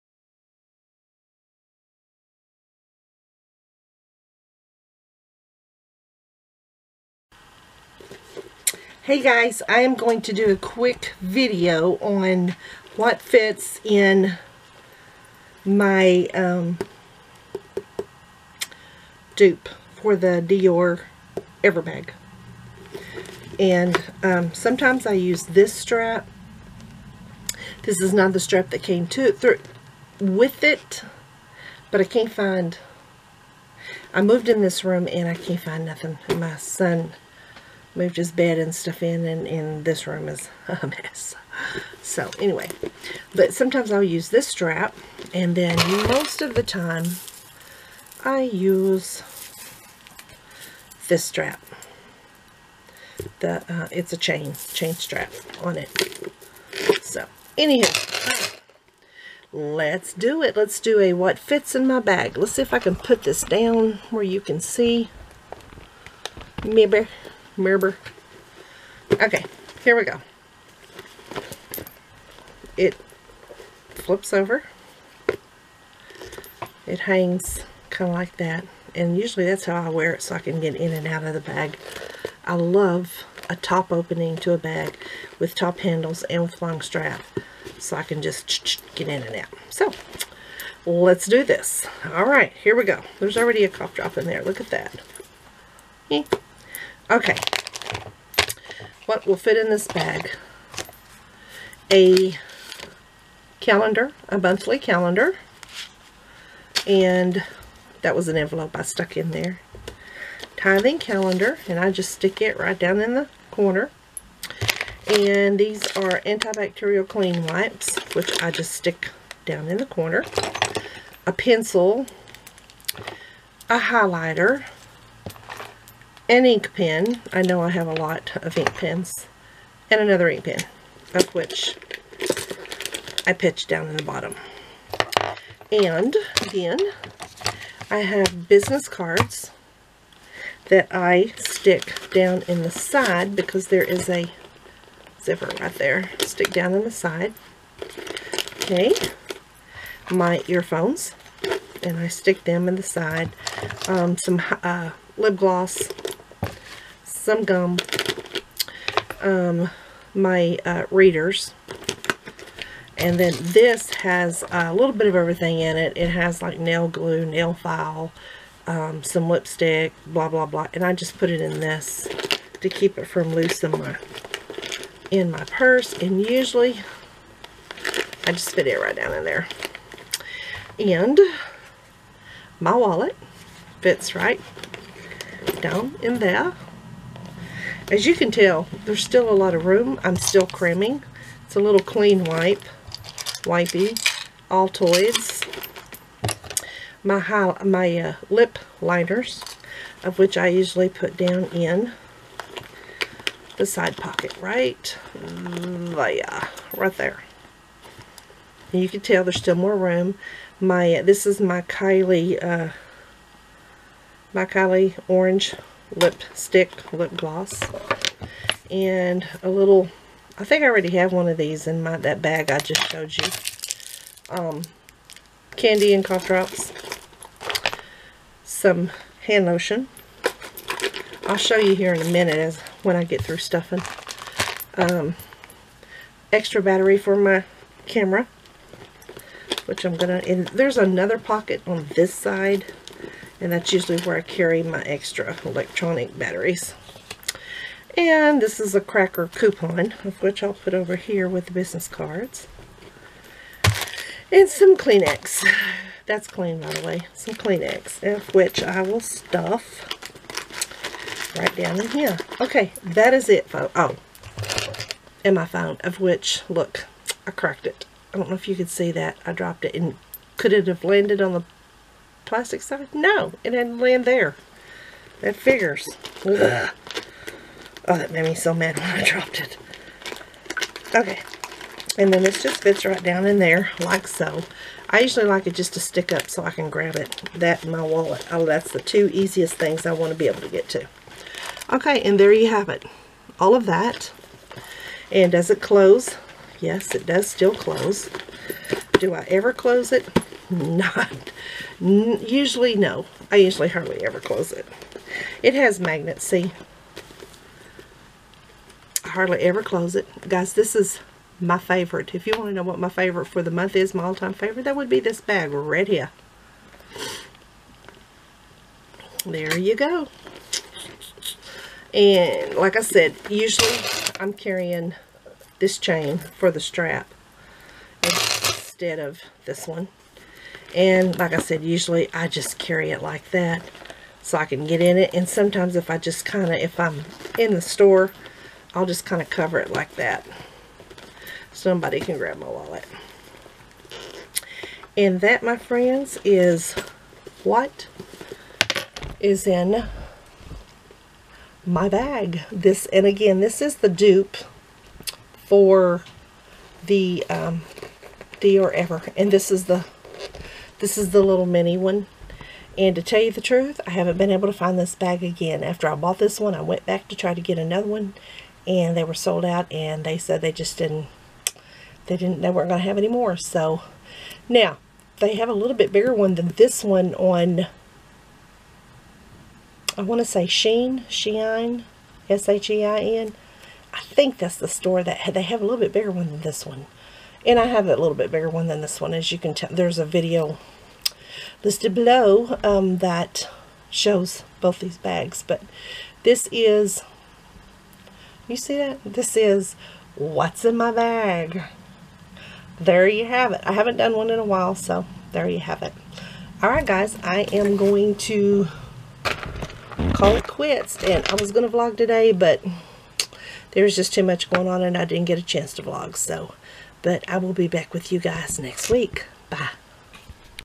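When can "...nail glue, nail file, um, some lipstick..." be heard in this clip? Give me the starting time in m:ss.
2:46.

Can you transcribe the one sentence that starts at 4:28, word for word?
I don't know if you could see that.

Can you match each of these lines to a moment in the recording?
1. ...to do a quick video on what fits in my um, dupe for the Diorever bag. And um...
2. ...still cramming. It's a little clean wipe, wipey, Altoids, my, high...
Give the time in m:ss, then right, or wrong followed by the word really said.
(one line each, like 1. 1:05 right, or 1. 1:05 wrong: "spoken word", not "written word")
1. 0:10 right
2. 3:10 right.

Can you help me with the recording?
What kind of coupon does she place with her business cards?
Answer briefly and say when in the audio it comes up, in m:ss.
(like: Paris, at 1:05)
cracker coupon, at 4:08.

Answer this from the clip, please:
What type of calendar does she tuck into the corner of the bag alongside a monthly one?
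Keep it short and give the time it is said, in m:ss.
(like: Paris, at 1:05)
Tithing calendar, at 1:50.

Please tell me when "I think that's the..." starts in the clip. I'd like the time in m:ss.
6:23.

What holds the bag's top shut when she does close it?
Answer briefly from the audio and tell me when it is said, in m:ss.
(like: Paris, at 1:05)
magnets, at 5:05.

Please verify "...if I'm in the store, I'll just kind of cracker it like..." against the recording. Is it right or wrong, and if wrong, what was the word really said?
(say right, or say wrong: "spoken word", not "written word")
wrong: "cover", not "cracker".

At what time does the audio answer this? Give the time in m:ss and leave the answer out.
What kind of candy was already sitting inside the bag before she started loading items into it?
1:33.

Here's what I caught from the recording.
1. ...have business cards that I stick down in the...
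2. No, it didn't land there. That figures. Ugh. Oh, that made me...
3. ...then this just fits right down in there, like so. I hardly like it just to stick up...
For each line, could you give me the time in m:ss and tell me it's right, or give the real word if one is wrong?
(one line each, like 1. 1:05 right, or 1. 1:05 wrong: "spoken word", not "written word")
1. 2:17 right
2. 4:32 right
3. 4:42 wrong: "usually", not "hardly".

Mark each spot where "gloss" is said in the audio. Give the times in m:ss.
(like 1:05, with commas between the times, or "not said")
2:35, 3:37.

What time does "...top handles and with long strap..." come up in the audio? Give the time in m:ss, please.
1:25.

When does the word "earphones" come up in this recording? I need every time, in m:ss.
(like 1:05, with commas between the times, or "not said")
2:30.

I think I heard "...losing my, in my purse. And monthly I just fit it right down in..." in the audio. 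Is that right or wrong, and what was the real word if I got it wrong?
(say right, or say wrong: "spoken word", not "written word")
wrong: "usually", not "monthly".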